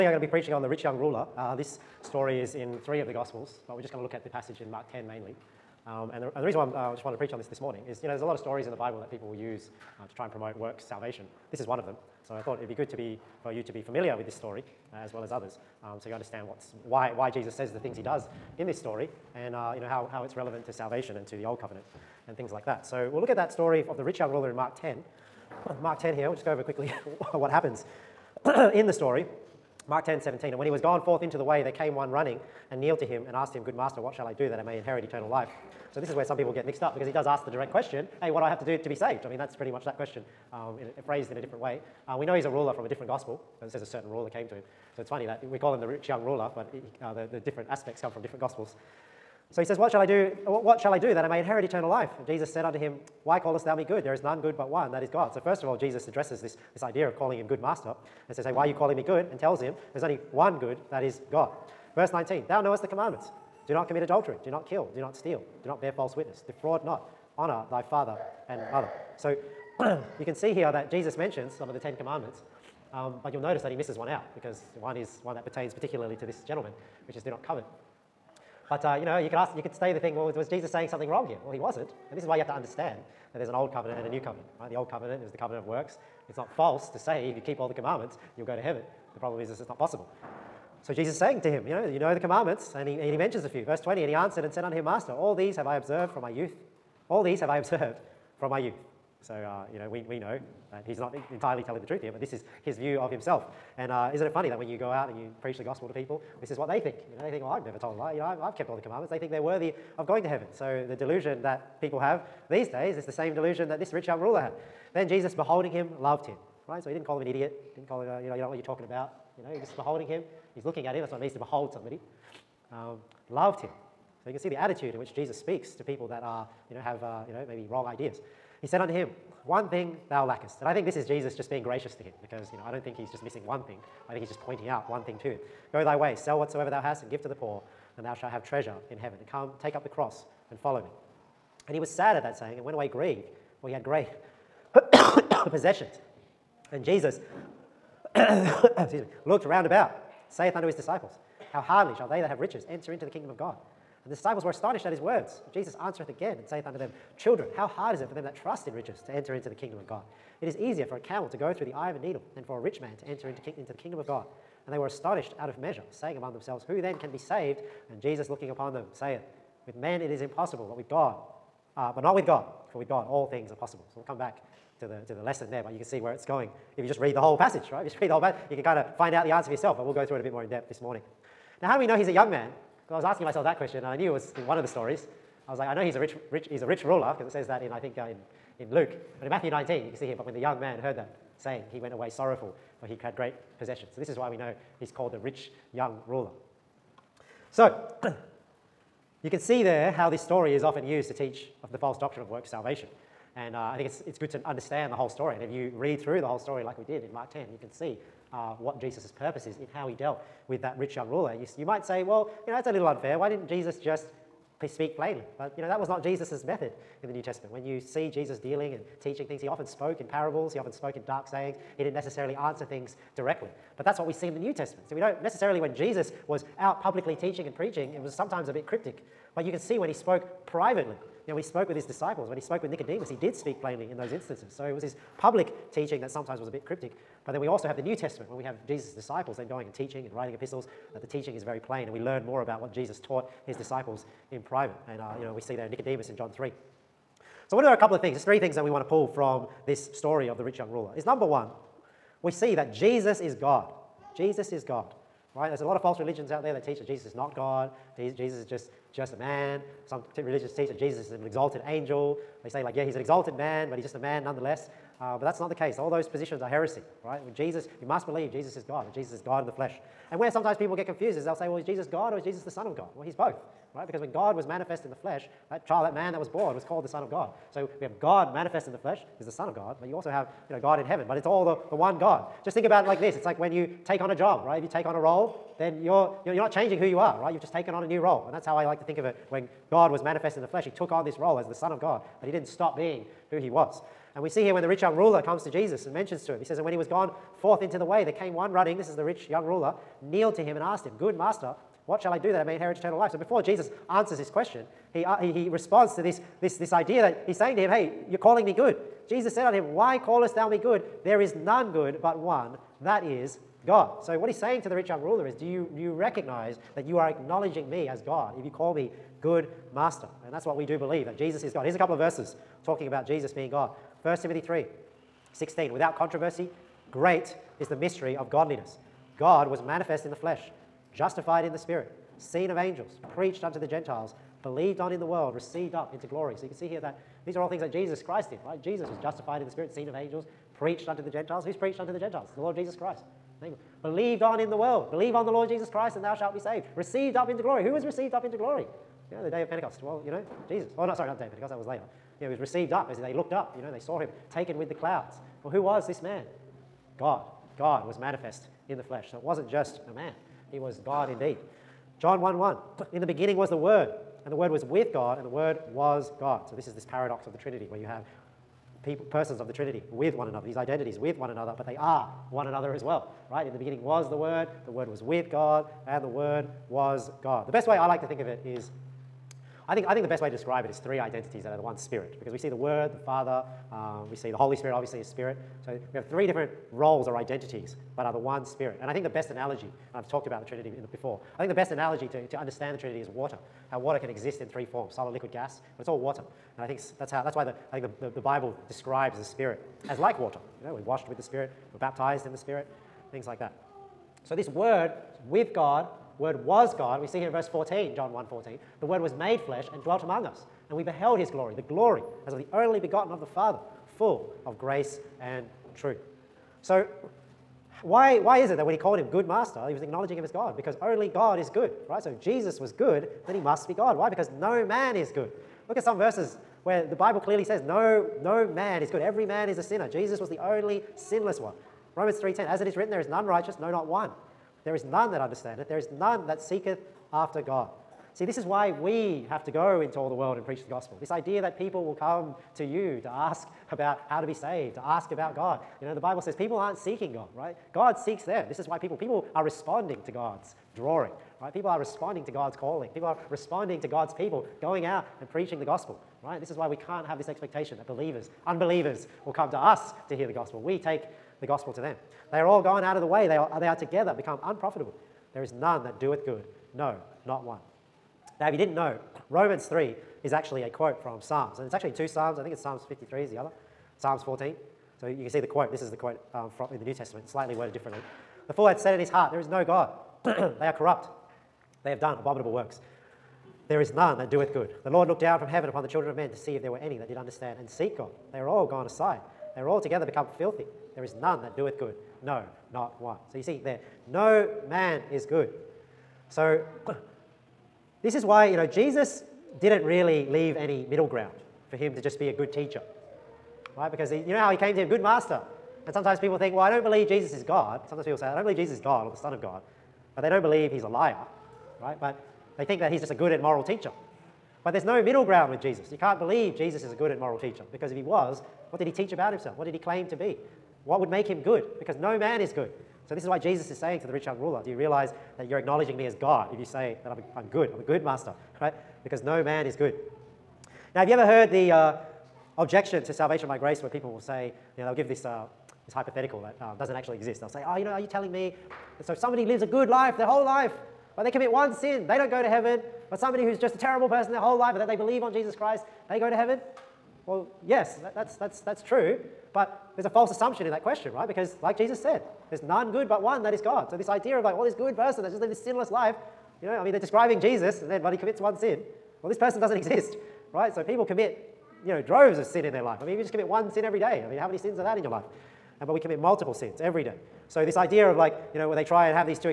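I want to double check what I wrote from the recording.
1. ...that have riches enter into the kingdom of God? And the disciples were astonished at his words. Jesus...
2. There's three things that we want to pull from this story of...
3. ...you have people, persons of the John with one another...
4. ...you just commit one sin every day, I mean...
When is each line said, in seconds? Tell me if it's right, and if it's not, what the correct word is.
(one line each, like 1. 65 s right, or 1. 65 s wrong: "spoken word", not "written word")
1. 152 s right
2. 248 s right
3. 367 s wrong: "Trinity", not "John"
4. 563 s right.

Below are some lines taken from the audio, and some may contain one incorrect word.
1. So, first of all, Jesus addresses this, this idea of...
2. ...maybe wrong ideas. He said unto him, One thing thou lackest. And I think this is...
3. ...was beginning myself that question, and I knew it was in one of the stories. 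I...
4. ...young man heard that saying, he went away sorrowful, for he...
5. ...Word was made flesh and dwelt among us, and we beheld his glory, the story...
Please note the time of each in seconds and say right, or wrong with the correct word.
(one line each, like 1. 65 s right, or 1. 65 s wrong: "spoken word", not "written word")
1. 55 s right
2. 127 s right
3. 183 s wrong: "asking", not "beginning"
4. 190 s right
5. 408 s wrong: "glory", not "story".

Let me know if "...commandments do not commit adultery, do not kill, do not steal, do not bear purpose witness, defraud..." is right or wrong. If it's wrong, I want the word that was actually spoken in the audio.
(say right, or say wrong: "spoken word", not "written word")
wrong: "false", not "purpose".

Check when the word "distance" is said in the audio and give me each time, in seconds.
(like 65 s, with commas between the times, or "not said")
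not said.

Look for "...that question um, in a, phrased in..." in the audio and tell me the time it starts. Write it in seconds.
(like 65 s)
39 s.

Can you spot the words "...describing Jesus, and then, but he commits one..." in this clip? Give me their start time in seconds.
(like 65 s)
556 s.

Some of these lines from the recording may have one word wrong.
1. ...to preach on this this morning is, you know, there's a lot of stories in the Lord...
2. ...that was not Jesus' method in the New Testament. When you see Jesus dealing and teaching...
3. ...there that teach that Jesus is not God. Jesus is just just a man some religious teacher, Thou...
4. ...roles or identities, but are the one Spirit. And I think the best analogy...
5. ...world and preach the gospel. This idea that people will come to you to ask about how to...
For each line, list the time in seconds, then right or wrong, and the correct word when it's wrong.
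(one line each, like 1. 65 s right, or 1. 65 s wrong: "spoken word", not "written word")
1. 7 s wrong: "Bible", not "Lord"
2. 215 s right
3. 256 s wrong: "Jesus", not "Thou"
4. 386 s right
5. 440 s right.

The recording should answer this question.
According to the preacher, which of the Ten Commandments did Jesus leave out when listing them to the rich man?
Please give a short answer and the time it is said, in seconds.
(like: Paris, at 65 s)
Do not covet, at 77 s.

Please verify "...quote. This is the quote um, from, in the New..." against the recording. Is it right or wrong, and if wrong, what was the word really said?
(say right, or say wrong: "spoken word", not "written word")
right.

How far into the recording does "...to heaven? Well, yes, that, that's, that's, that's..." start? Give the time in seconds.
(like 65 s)
546 s.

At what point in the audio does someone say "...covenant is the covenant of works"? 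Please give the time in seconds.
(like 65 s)
84 s.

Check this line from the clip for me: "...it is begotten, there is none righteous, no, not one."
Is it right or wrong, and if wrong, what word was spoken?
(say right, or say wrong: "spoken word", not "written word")
wrong: "written", not "begotten".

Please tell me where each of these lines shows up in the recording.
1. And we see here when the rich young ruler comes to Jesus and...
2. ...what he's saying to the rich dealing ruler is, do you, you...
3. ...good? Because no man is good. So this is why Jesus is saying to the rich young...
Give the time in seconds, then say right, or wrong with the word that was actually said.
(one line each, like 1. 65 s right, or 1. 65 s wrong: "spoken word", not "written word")
1. 294 s right
2. 314 s wrong: "young", not "dealing"
3. 521 s right.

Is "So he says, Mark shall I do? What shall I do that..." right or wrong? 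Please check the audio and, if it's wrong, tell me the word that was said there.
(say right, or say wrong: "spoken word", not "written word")
wrong: "What", not "Mark".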